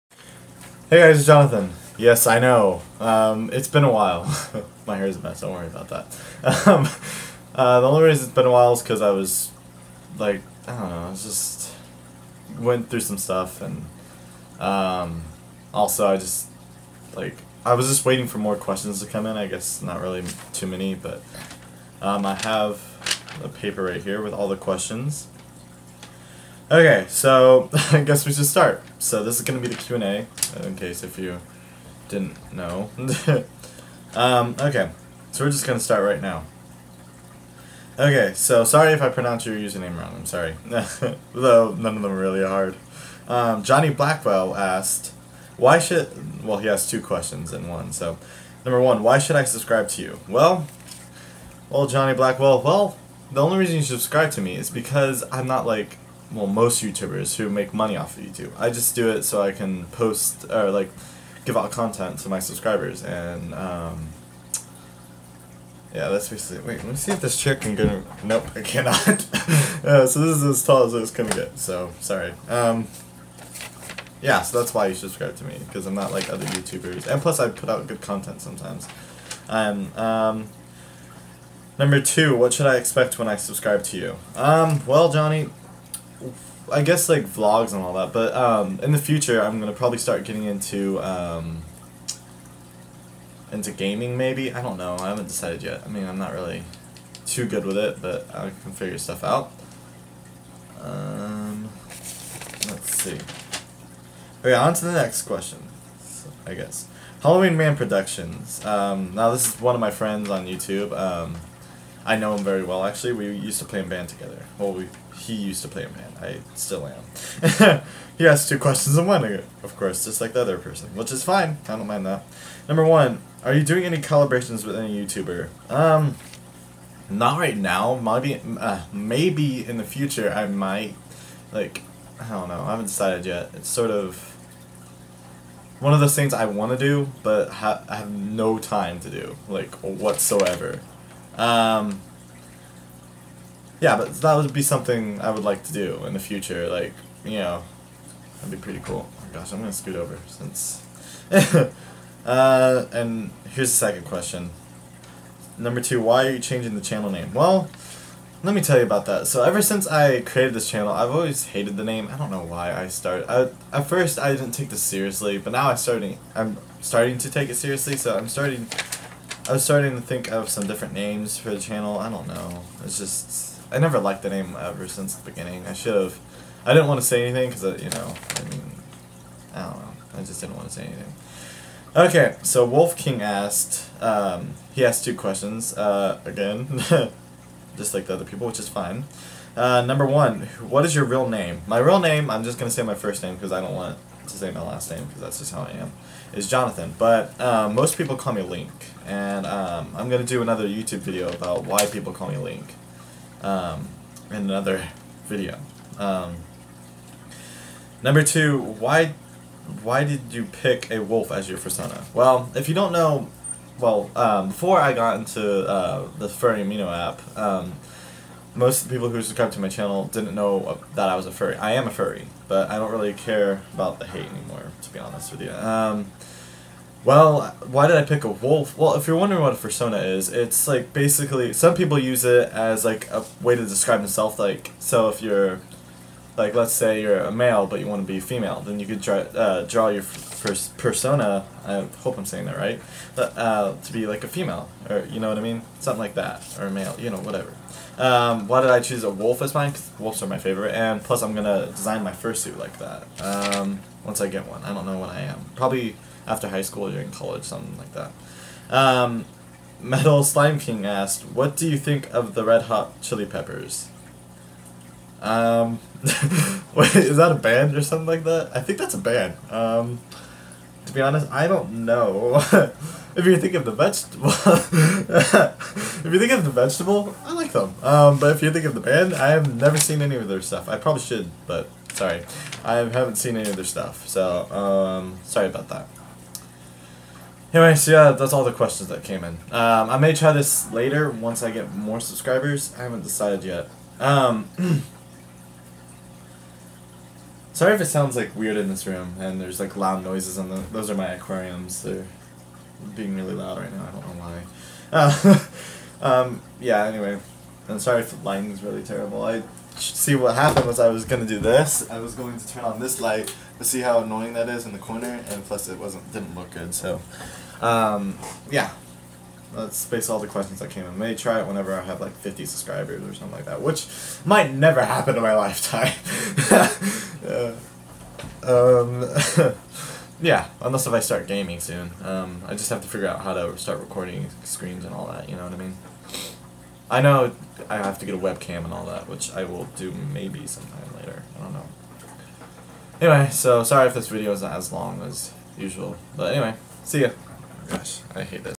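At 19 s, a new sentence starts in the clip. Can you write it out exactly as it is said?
I guess not really too many, but um, I have a paper right here with all the questions.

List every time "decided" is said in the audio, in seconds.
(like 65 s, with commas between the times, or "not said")
95 s, 132 s, 293 s.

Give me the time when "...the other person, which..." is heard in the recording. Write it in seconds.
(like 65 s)
120 s.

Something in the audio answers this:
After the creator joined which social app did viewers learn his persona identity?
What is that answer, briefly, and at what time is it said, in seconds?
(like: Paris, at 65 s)
Furry Amino, at 216 s.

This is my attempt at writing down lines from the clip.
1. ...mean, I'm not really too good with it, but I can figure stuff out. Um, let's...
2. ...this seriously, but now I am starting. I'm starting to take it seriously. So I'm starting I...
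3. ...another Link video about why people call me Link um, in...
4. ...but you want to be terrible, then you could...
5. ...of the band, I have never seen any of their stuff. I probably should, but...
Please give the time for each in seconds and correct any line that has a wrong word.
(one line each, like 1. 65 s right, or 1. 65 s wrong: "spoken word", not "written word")
1. 95 s right
2. 164 s right
3. 200 s wrong: "YouTube", not "Link"
4. 237 s wrong: "female", not "terrible"
5. 278 s right.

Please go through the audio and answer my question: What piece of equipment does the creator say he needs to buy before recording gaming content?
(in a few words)
a webcam.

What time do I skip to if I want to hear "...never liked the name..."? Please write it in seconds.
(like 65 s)
173 s.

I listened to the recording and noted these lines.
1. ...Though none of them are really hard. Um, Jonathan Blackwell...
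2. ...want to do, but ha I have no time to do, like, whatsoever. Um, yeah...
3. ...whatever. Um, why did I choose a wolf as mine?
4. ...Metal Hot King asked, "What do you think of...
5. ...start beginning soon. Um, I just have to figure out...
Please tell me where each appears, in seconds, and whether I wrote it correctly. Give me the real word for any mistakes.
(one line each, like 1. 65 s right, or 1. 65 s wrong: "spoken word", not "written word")
1. 41 s wrong: "Johnny", not "Jonathan"
2. 136 s right
3. 247 s right
4. 259 s wrong: "Slime", not "Hot"
5. 330 s wrong: "gaming", not "beginning".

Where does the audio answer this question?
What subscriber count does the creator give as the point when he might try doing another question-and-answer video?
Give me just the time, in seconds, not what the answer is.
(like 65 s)
322 s.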